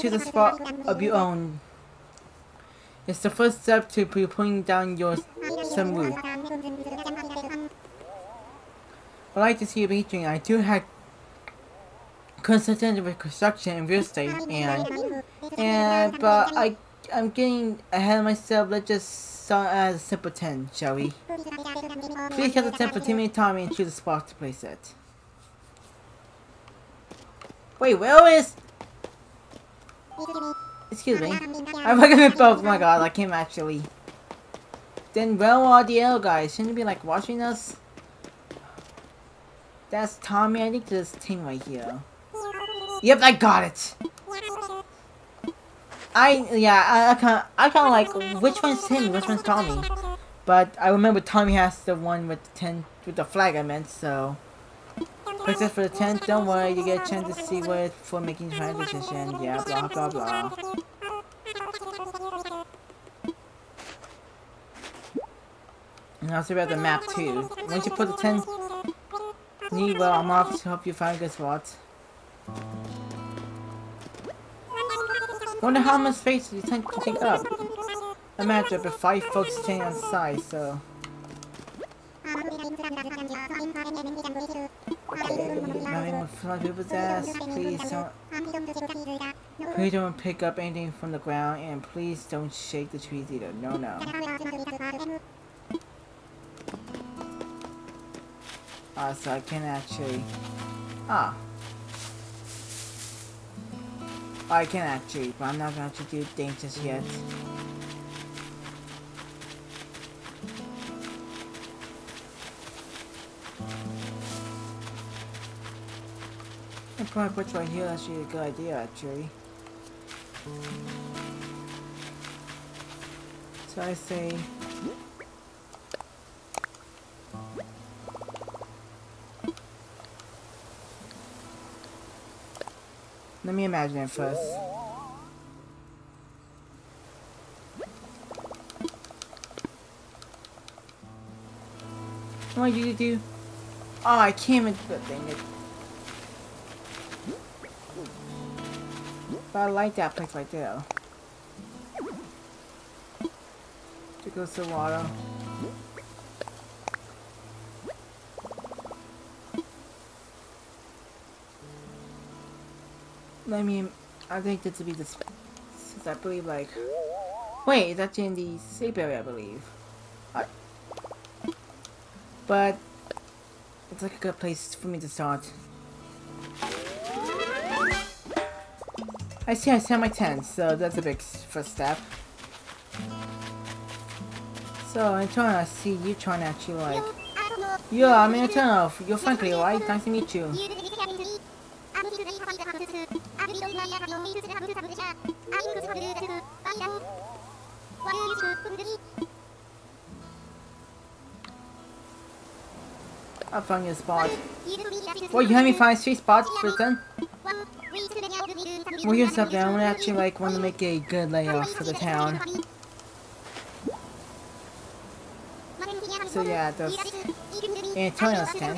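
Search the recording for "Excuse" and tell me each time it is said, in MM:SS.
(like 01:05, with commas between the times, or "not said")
00:30.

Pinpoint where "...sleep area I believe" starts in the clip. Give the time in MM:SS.
02:48.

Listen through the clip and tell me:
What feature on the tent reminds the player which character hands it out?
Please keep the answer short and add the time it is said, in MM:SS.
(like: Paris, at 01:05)
flag, at 00:53.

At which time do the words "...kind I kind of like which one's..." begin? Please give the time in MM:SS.
00:47.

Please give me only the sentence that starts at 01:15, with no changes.
Wonder how much space you tend to take up.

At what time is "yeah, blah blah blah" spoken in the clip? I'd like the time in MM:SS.
00:59.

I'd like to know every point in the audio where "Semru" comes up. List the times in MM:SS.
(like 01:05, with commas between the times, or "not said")
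00:05.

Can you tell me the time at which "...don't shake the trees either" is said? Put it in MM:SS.
01:32.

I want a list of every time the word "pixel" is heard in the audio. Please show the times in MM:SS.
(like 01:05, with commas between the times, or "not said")
not said.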